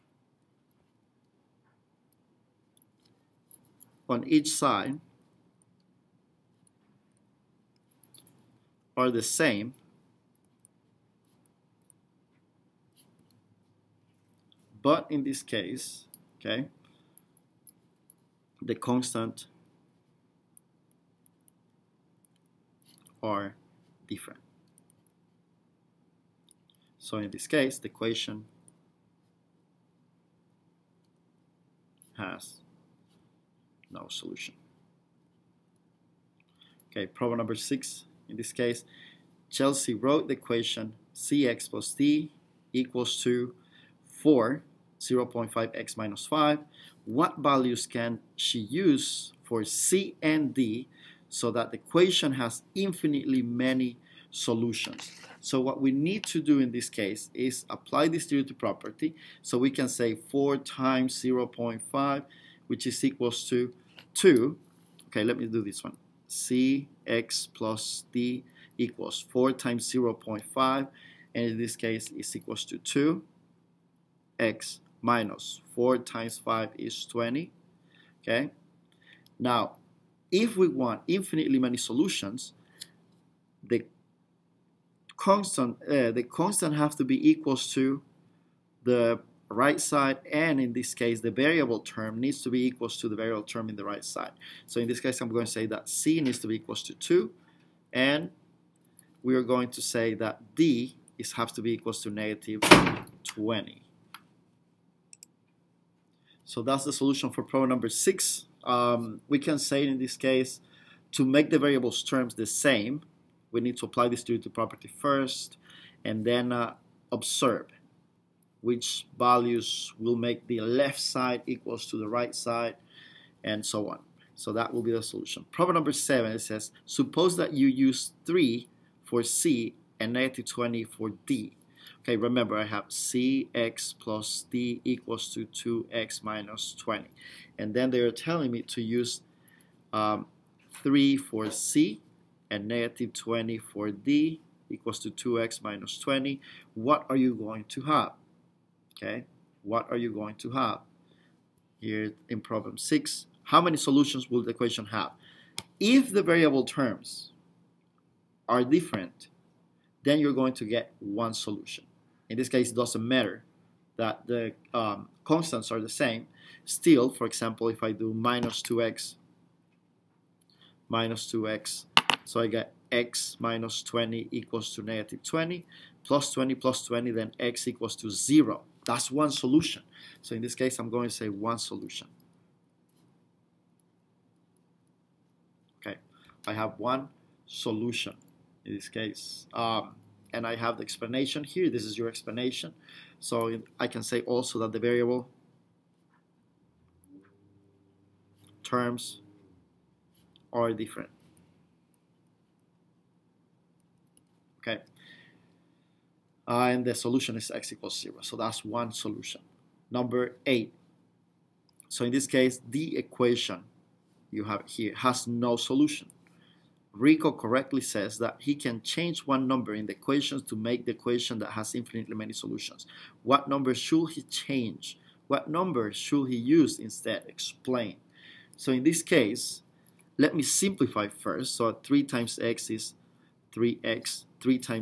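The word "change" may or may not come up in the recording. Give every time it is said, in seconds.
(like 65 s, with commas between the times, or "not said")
218 s, 224 s.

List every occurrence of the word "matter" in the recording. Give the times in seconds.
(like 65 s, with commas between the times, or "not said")
163 s.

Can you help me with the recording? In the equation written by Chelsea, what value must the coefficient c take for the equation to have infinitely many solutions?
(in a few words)
2.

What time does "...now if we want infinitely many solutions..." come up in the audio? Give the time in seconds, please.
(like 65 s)
79 s.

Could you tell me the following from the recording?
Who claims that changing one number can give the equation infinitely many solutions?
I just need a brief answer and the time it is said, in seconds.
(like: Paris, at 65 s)
Rico, at 216 s.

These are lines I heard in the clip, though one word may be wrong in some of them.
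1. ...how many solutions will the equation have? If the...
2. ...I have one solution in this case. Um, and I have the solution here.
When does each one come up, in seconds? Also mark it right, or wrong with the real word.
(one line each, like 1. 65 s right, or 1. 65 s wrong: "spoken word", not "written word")
1. 153 s right
2. 186 s wrong: "explanation", not "solution".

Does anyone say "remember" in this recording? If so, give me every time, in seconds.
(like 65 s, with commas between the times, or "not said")
132 s.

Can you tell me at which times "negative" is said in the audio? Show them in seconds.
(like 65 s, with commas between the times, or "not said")
102 s, 130 s, 142 s, 174 s.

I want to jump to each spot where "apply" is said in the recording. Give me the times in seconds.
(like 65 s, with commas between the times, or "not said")
57 s, 113 s.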